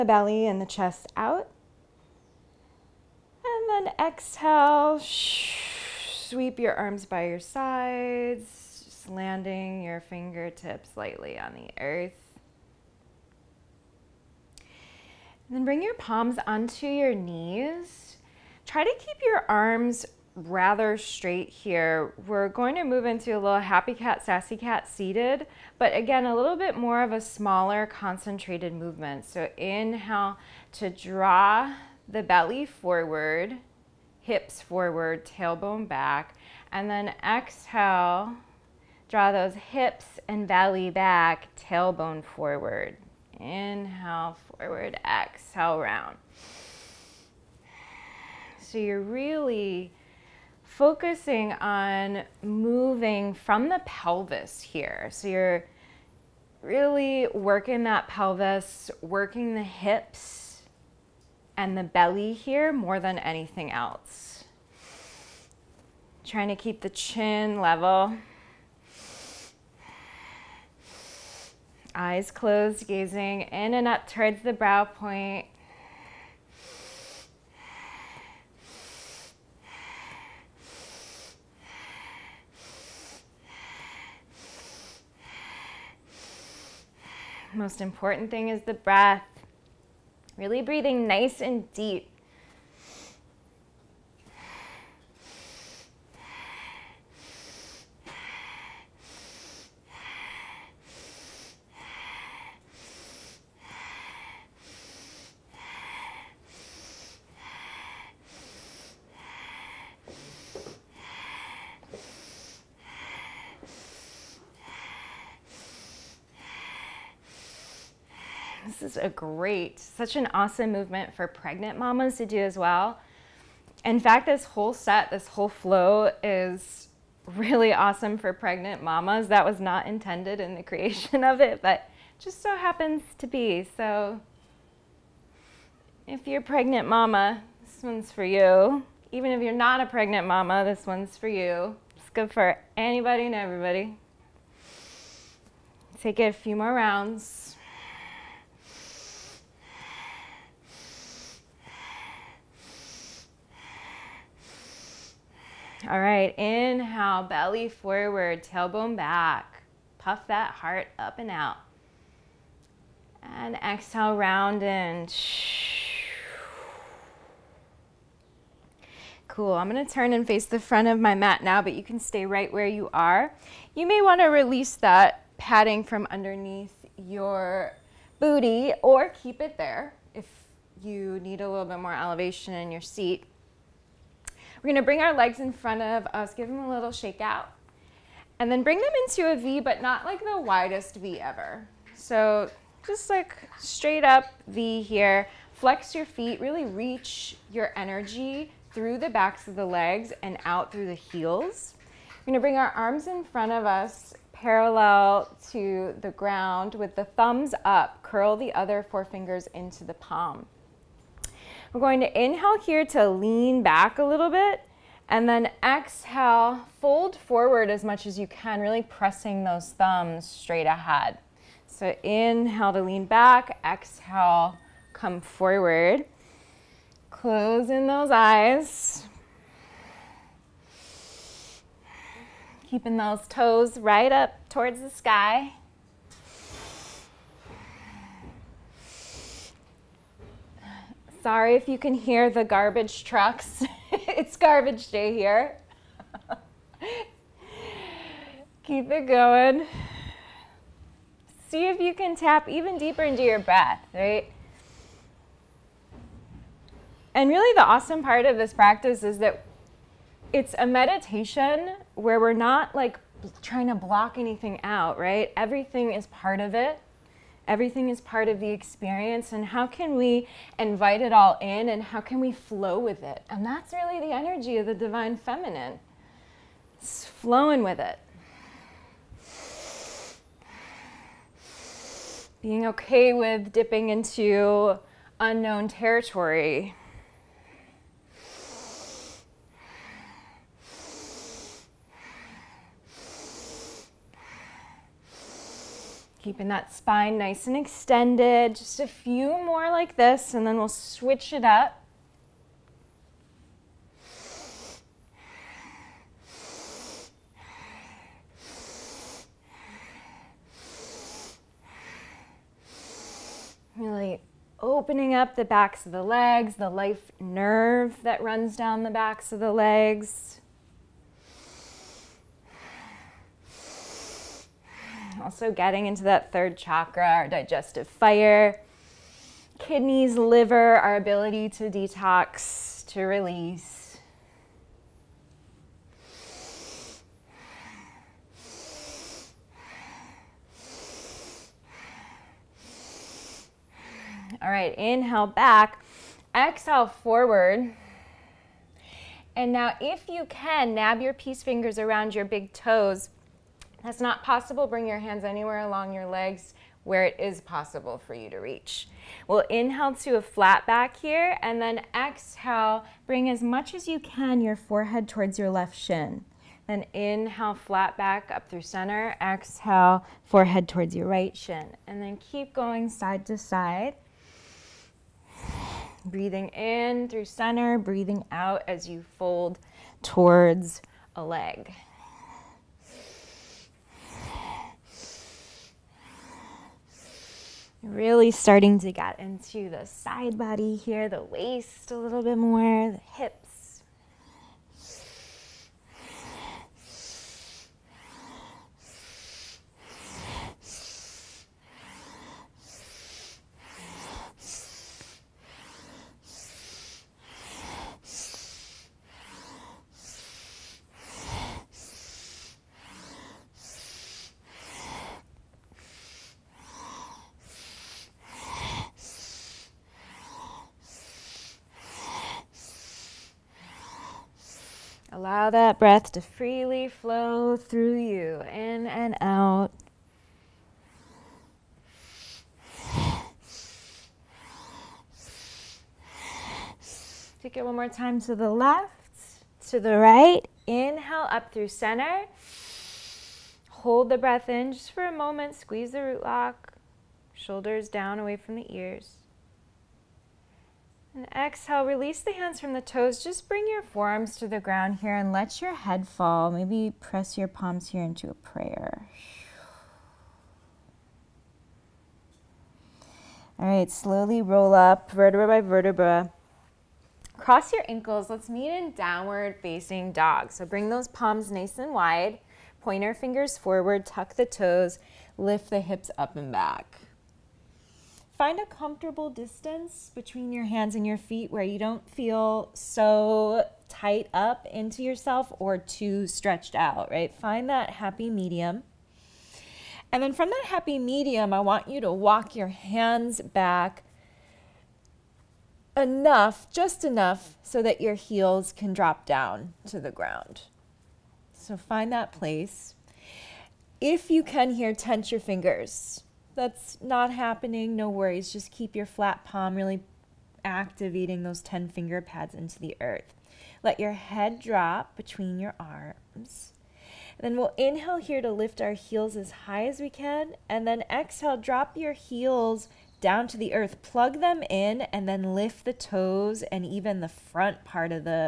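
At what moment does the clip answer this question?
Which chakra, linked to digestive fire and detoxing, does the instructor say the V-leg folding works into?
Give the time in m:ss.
5:26.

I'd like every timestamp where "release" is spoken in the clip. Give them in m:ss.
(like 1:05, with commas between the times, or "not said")
2:54, 5:33, 7:31.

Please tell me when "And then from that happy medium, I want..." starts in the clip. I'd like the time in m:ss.
8:10.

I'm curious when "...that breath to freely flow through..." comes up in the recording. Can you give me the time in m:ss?
7:05.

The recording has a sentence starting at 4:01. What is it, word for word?
Sorry if you can hear the garbage trucks.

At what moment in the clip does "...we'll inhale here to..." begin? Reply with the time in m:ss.
8:37.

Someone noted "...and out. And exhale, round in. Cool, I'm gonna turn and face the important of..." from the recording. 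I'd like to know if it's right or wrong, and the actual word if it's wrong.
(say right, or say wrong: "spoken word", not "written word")
wrong: "front", not "important".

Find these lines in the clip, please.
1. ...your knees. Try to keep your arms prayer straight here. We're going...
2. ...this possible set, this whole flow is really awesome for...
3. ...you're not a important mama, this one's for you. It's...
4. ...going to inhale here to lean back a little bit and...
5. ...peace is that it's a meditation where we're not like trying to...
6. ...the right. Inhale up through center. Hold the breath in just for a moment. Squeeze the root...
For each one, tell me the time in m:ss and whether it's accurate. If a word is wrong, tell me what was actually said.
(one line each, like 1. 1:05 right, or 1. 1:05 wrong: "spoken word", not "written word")
1. 0:16 wrong: "rather", not "prayer"
2. 2:04 wrong: "whole", not "possible"
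3. 2:19 wrong: "pregnant", not "important"
4. 3:31 right
5. 4:18 wrong: "practice", not "peace"
6. 7:19 right.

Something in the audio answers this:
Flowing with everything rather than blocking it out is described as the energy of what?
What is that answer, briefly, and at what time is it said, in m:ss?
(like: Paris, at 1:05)
The divine feminine, at 4:34.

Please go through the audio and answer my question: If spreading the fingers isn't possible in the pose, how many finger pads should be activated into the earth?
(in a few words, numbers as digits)
10.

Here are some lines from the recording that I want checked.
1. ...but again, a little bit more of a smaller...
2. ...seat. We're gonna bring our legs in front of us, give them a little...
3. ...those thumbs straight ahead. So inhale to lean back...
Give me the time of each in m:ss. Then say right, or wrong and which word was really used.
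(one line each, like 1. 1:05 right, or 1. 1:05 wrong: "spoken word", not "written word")
1. 0:25 right
2. 3:02 right
3. 3:39 right.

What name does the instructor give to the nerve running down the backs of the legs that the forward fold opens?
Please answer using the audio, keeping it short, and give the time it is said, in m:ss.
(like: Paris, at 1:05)
Life nerve, at 5:16.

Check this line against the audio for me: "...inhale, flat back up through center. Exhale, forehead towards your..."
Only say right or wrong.
right.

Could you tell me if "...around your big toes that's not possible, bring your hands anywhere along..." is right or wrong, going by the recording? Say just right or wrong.
right.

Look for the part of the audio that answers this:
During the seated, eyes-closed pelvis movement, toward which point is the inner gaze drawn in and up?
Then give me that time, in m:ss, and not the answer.
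1:14.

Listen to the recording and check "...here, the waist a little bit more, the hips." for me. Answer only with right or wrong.
right.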